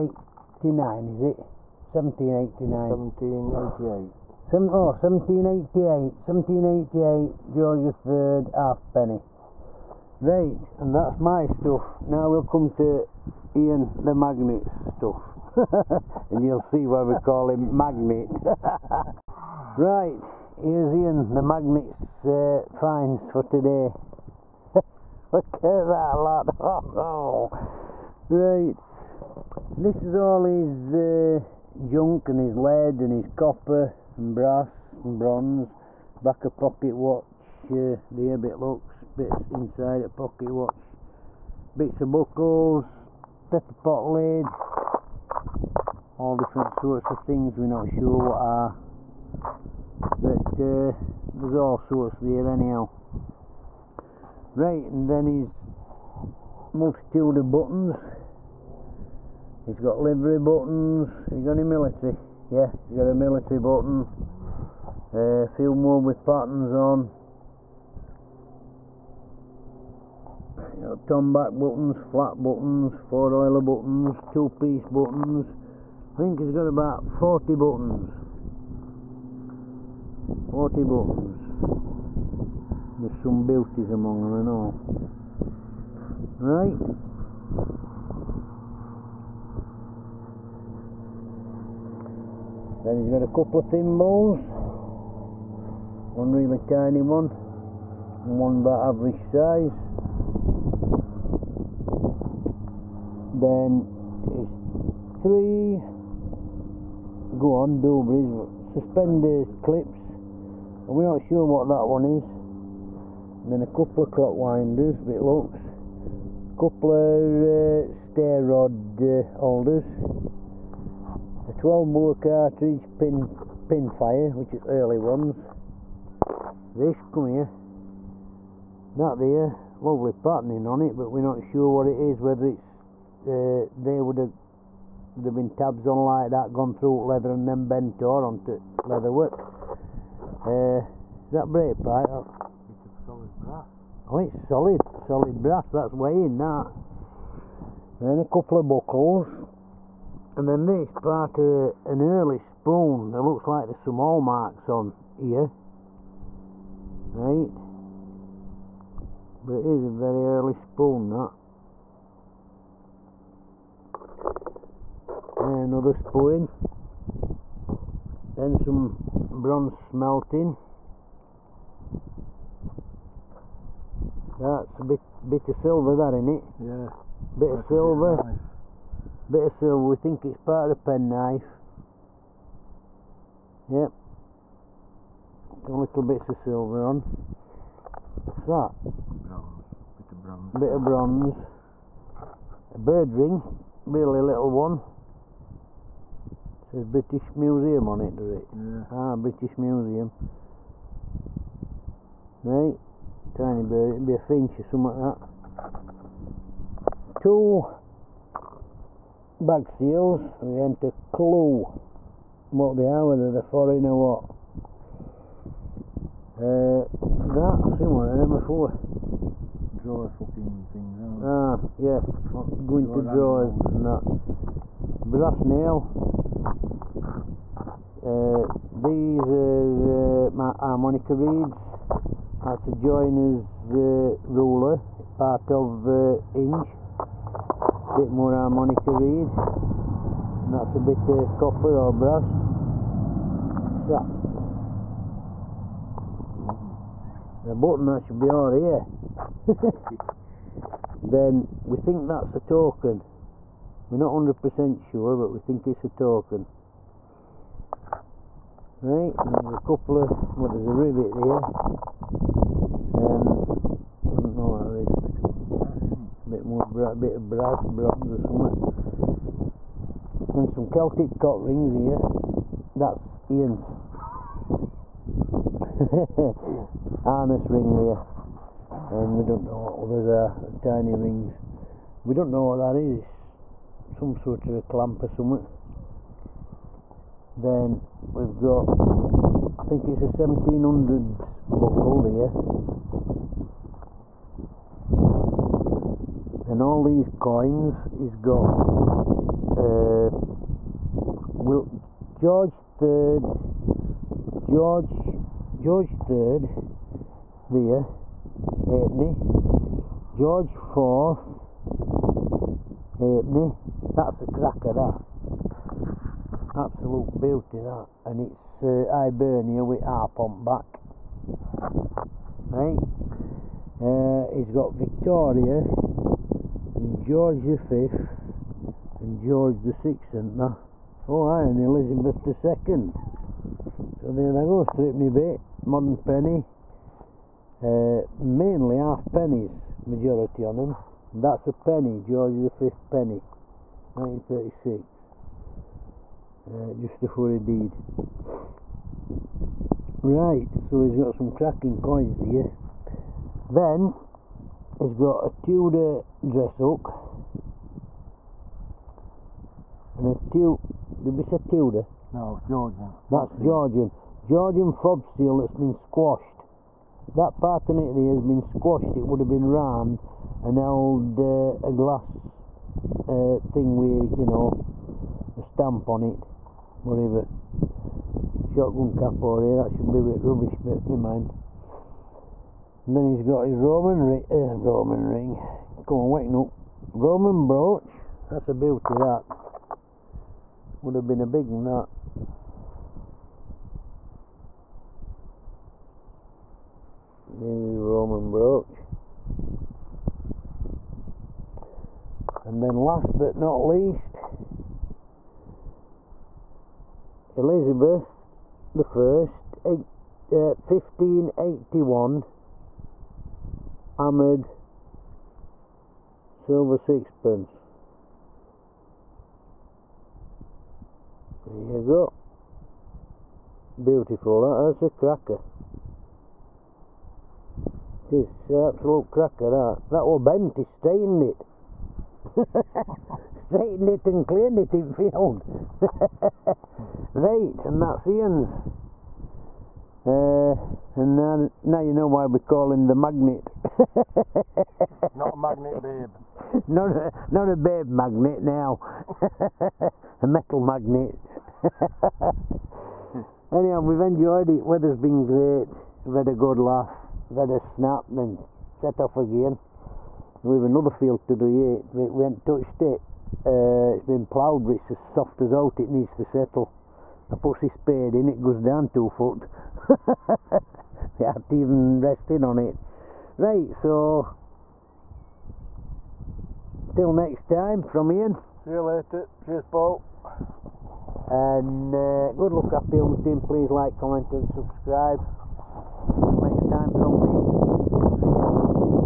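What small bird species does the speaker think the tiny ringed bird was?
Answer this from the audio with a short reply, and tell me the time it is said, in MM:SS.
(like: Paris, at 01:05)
Finch, at 03:24.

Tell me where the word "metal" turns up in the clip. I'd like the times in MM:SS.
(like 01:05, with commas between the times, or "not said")
07:30.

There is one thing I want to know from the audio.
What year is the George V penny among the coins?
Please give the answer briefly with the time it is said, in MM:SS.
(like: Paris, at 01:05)
1936, at 05:43.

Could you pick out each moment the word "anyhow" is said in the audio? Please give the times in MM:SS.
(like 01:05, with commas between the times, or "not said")
00:52, 07:33.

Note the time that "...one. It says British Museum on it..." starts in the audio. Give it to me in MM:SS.
03:14.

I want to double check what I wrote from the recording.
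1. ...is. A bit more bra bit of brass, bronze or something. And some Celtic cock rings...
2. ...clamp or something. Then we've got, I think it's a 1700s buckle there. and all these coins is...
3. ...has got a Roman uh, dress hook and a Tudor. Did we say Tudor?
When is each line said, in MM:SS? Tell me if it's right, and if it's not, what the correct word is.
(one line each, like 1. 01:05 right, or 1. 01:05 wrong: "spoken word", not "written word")
1. 04:24 right
2. 04:44 right
3. 05:54 wrong: "Tudor", not "Roman".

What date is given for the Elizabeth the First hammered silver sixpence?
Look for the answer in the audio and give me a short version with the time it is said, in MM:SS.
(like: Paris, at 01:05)
1581, at 06:50.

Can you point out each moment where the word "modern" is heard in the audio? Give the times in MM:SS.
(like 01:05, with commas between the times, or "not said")
05:35.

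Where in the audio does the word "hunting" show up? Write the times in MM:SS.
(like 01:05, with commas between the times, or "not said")
08:02.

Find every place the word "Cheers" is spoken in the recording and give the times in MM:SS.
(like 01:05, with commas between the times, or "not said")
07:59.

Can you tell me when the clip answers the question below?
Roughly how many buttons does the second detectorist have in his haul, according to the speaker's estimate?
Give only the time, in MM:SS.
01:16.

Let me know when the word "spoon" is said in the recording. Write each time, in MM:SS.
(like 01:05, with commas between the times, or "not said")
02:32, 02:40, 02:45.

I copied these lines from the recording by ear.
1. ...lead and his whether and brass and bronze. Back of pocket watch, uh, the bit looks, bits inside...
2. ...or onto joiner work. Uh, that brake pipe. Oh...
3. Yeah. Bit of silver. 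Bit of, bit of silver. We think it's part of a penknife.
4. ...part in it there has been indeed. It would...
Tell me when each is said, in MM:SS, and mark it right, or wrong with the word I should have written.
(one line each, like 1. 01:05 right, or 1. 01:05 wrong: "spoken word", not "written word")
1. 00:32 wrong: "copper", not "whether"
2. 02:18 wrong: "leather", not "joiner"
3. 02:56 right
4. 06:07 wrong: "squashed", not "indeed".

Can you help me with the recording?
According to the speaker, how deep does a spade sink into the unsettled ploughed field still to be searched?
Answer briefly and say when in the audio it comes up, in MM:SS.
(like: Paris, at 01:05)
Two foot, at 07:48.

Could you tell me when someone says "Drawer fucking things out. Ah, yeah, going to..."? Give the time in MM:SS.
03:39.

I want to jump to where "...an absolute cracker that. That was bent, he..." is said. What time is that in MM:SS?
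07:08.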